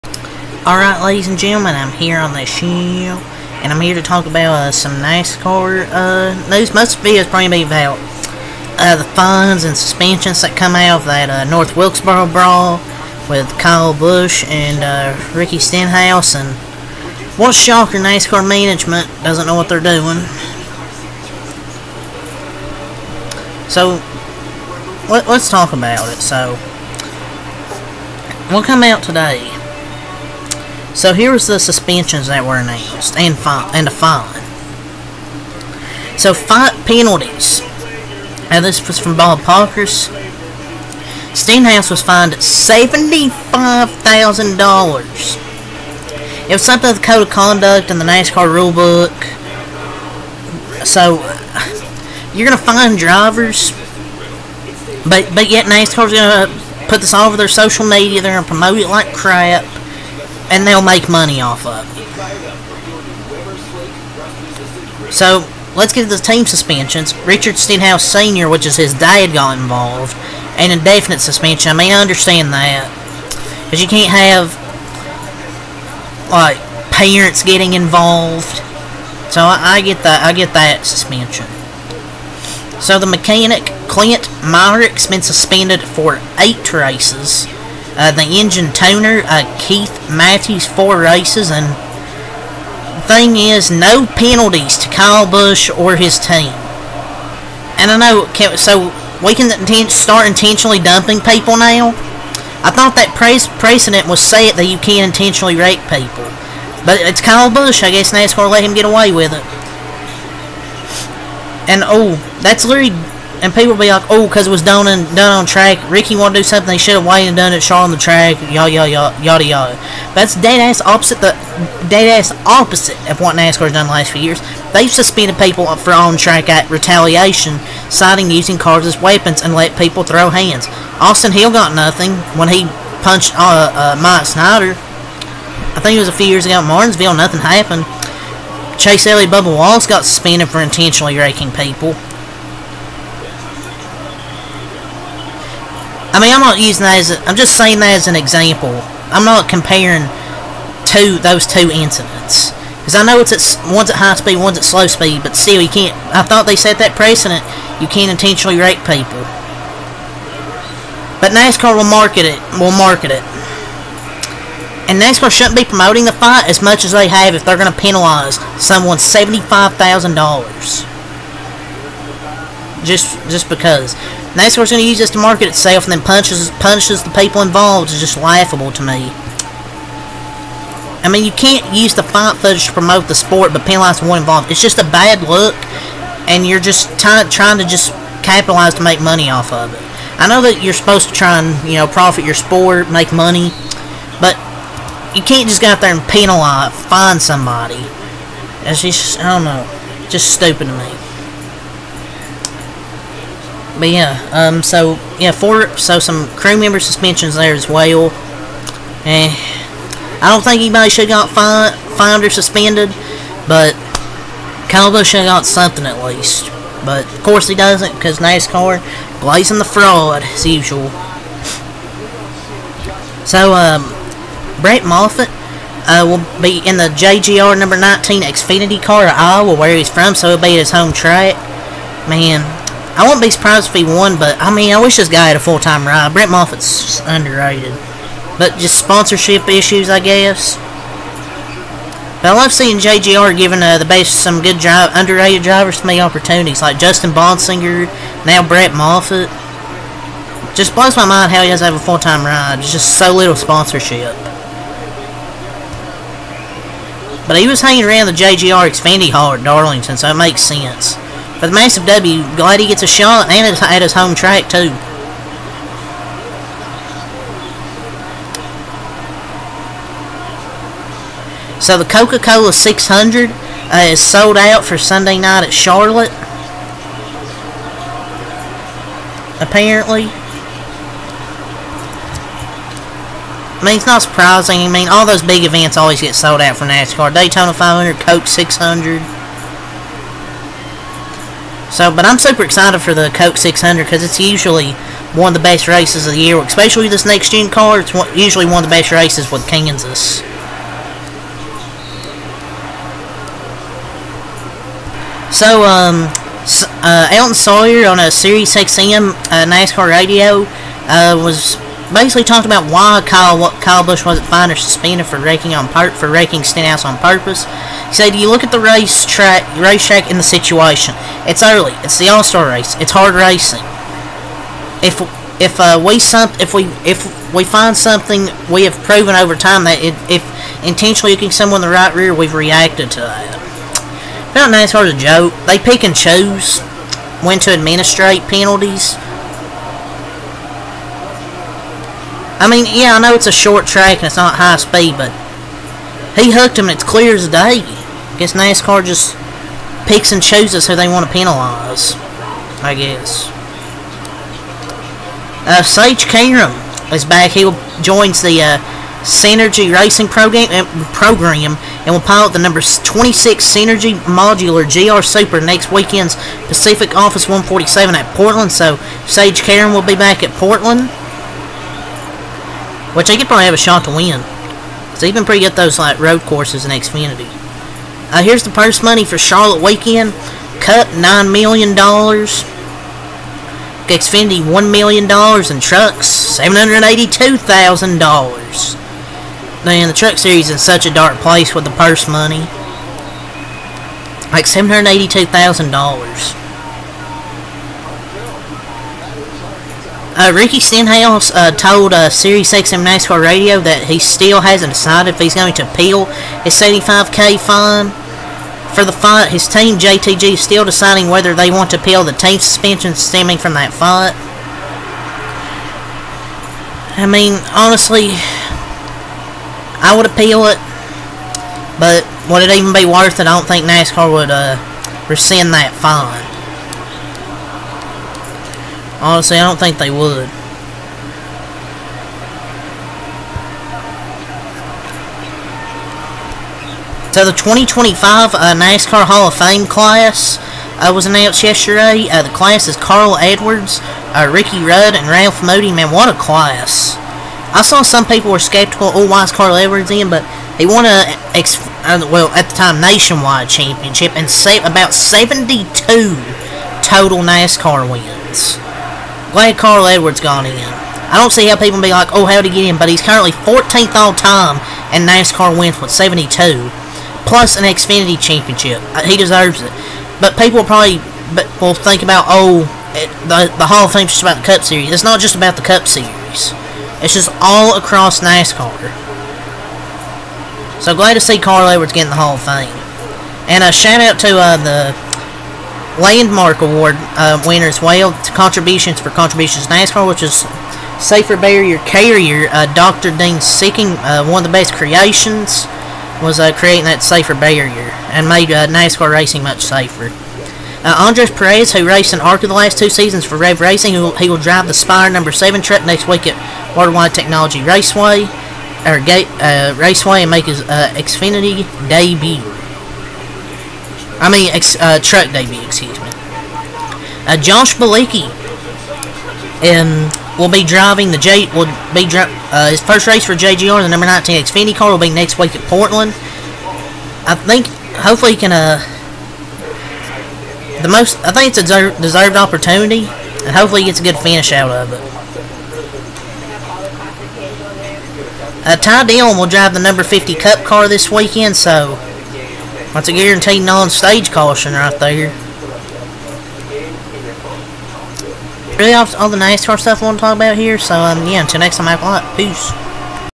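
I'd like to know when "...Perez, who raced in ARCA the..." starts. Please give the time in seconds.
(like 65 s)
501 s.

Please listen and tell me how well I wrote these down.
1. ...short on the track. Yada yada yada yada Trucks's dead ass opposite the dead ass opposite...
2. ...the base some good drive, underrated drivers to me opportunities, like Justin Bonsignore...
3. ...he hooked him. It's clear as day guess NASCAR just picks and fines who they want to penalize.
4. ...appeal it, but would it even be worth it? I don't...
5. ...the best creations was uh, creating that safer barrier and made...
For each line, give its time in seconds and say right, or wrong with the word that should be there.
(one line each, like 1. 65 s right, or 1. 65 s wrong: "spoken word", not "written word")
1. 117 s wrong: "That", not "Trucks"
2. 243 s right
3. 346 s wrong: "chooses", not "fines"
4. 420 s right
5. 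494 s right.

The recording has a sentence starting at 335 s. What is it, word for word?
They pick and choose when to administrate penalties.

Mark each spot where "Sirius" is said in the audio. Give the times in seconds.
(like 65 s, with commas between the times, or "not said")
308 s, 402 s.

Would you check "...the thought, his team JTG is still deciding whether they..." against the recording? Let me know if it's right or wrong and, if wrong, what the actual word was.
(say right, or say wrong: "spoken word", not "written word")
wrong: "fight", not "thought".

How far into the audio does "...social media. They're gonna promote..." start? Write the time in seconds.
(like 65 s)
57 s.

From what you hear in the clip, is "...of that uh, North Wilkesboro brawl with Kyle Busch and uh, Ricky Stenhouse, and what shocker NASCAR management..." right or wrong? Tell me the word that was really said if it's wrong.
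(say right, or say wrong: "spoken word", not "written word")
right.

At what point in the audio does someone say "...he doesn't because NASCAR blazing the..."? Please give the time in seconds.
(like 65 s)
217 s.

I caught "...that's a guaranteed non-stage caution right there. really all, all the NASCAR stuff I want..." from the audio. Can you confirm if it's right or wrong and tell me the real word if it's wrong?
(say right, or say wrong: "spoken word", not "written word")
right.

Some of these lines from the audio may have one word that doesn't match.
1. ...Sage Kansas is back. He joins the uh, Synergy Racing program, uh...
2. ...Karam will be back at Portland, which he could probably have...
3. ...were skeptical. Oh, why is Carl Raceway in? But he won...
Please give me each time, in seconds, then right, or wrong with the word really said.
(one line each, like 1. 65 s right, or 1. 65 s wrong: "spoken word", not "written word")
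1. 355 s wrong: "Karam", not "Kansas"
2. 369 s right
3. 448 s wrong: "Edwards", not "Raceway".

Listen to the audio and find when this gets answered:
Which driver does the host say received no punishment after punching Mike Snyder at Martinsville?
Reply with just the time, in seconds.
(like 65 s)
131 s.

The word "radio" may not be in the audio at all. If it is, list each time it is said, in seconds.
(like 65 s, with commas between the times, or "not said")
309 s, 403 s.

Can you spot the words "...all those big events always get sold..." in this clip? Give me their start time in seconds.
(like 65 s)
284 s.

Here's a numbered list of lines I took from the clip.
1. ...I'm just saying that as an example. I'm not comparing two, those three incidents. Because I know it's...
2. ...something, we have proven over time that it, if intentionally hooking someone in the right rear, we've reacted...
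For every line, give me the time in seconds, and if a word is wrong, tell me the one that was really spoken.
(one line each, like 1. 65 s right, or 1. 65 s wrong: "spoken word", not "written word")
1. 147 s wrong: "two", not "three"
2. 327 s right.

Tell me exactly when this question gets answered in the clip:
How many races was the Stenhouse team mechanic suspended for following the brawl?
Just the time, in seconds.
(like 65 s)
86 s.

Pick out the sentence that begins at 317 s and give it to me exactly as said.
He said, "You look at the race track, racetrack, and the situation.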